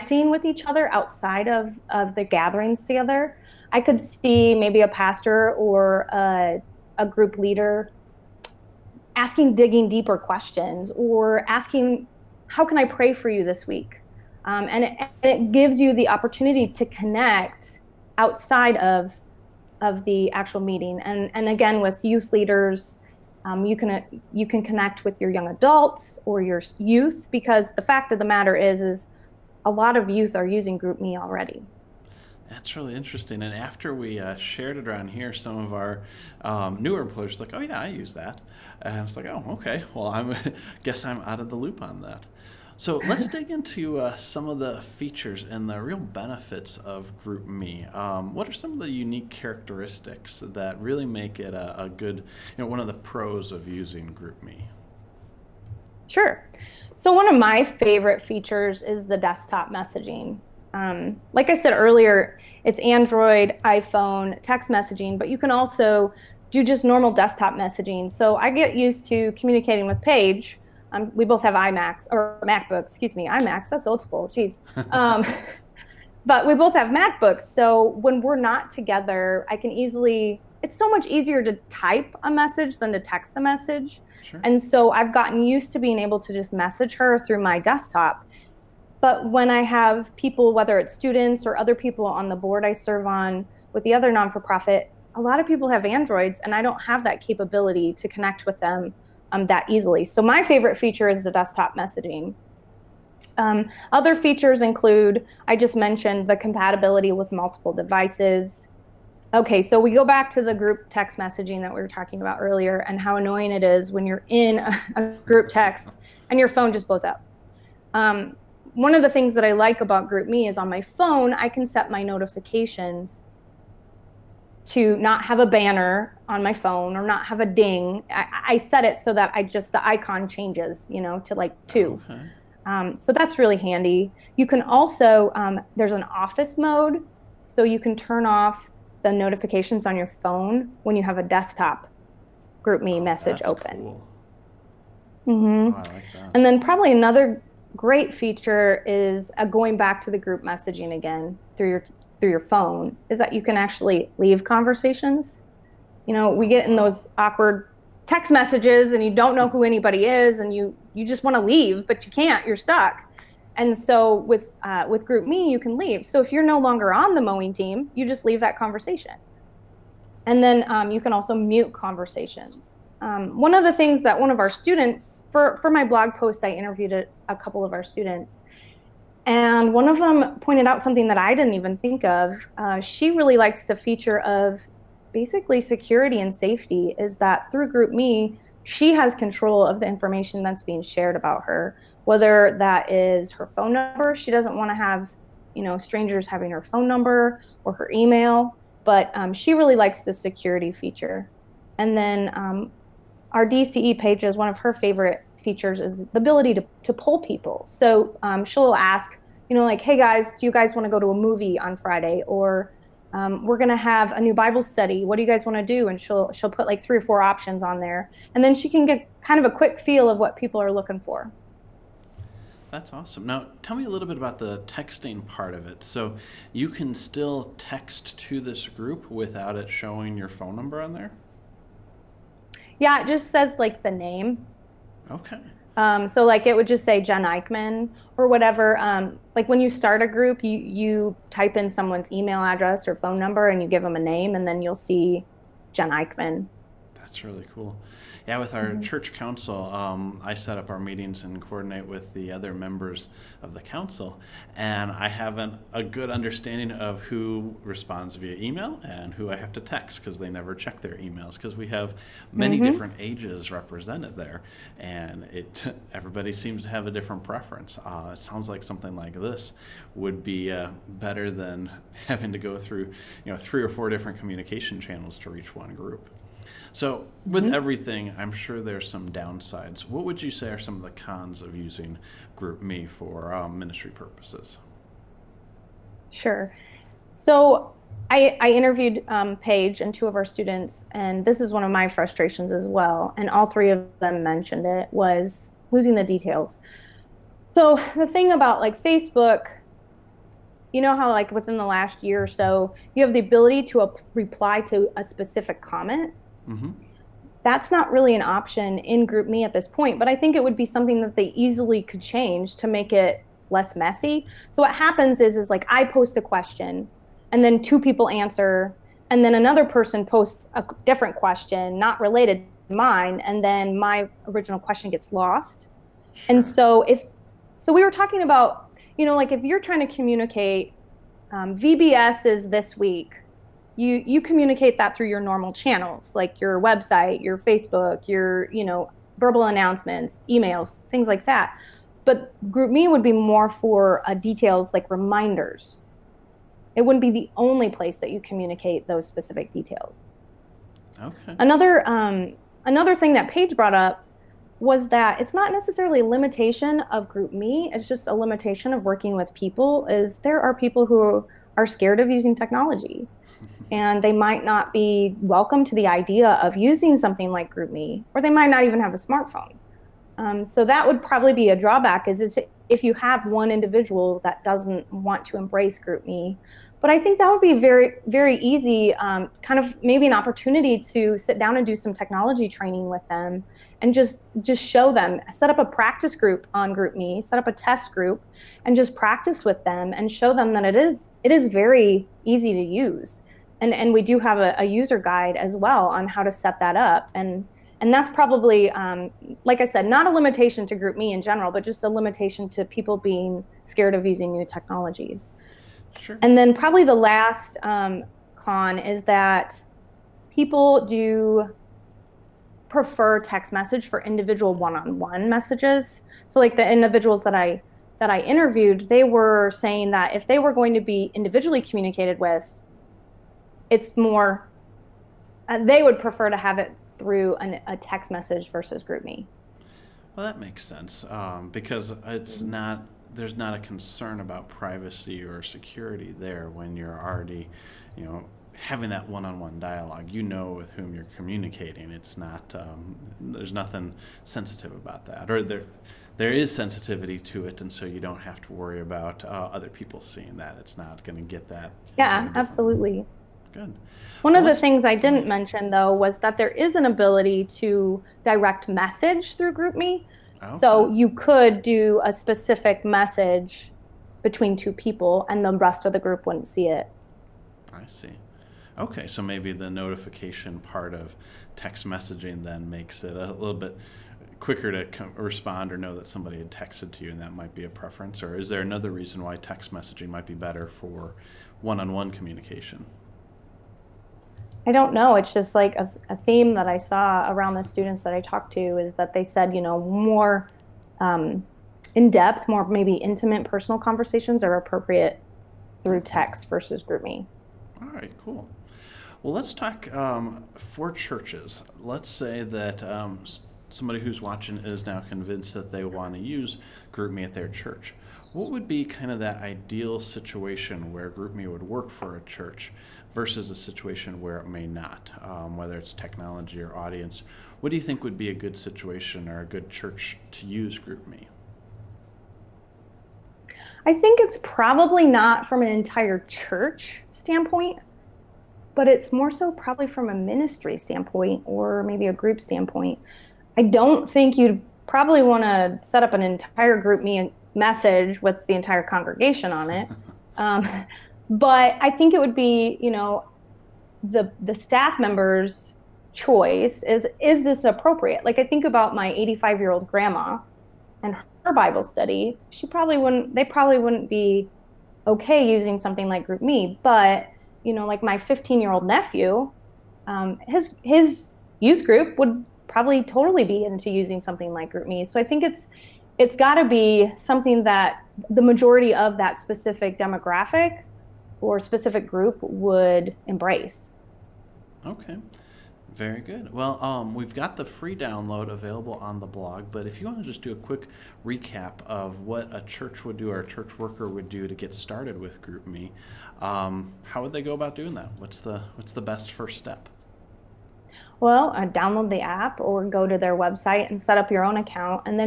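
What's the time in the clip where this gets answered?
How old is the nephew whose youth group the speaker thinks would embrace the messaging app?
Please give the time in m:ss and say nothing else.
9:18.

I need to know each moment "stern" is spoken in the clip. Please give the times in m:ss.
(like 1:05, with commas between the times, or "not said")
not said.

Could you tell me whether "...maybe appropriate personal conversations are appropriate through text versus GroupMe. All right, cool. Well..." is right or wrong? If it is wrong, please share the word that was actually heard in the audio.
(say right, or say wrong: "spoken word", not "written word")
wrong: "intimate", not "appropriate".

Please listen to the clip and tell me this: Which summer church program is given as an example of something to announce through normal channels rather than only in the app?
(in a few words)
VBS.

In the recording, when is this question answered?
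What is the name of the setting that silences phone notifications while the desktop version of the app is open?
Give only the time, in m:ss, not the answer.
2:16.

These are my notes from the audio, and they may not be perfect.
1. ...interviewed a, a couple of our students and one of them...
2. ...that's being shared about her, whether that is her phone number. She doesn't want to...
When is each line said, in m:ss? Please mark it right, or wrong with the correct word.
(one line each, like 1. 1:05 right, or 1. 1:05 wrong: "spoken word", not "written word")
1. 2:56 right
2. 3:10 right.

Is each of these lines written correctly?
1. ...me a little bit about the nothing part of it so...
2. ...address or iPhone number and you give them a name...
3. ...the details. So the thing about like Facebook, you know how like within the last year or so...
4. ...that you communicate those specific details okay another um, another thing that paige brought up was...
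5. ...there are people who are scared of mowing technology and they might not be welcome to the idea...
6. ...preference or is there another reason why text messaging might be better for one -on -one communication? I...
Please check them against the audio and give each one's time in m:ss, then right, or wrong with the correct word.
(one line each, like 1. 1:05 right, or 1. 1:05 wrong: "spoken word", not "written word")
1. 3:43 wrong: "texting", not "nothing"
2. 4:02 wrong: "phone", not "iPhone"
3. 4:55 right
4. 5:47 right
5. 6:00 wrong: "using", not "mowing"
6. 7:57 right.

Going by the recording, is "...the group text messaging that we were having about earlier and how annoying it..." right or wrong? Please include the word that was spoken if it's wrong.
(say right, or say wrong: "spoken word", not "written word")
wrong: "talking", not "having".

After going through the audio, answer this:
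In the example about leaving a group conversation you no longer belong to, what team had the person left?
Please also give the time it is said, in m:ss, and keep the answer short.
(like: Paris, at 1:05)
Mowing team, at 2:47.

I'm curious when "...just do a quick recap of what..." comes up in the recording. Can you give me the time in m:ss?
9:40.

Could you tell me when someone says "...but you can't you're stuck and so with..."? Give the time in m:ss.
2:41.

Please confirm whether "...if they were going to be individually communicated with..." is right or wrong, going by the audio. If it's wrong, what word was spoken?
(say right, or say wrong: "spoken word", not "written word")
right.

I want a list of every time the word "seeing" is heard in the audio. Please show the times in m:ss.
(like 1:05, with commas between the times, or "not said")
7:30.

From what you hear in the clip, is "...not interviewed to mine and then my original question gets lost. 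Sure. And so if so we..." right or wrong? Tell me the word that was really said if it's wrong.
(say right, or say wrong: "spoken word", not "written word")
wrong: "related", not "interviewed".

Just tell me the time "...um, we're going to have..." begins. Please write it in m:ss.
3:33.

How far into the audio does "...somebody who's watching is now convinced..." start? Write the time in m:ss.
8:23.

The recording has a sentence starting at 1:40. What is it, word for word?
So my favorite feature is the desktop messaging.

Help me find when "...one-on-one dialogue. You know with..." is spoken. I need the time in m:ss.
7:19.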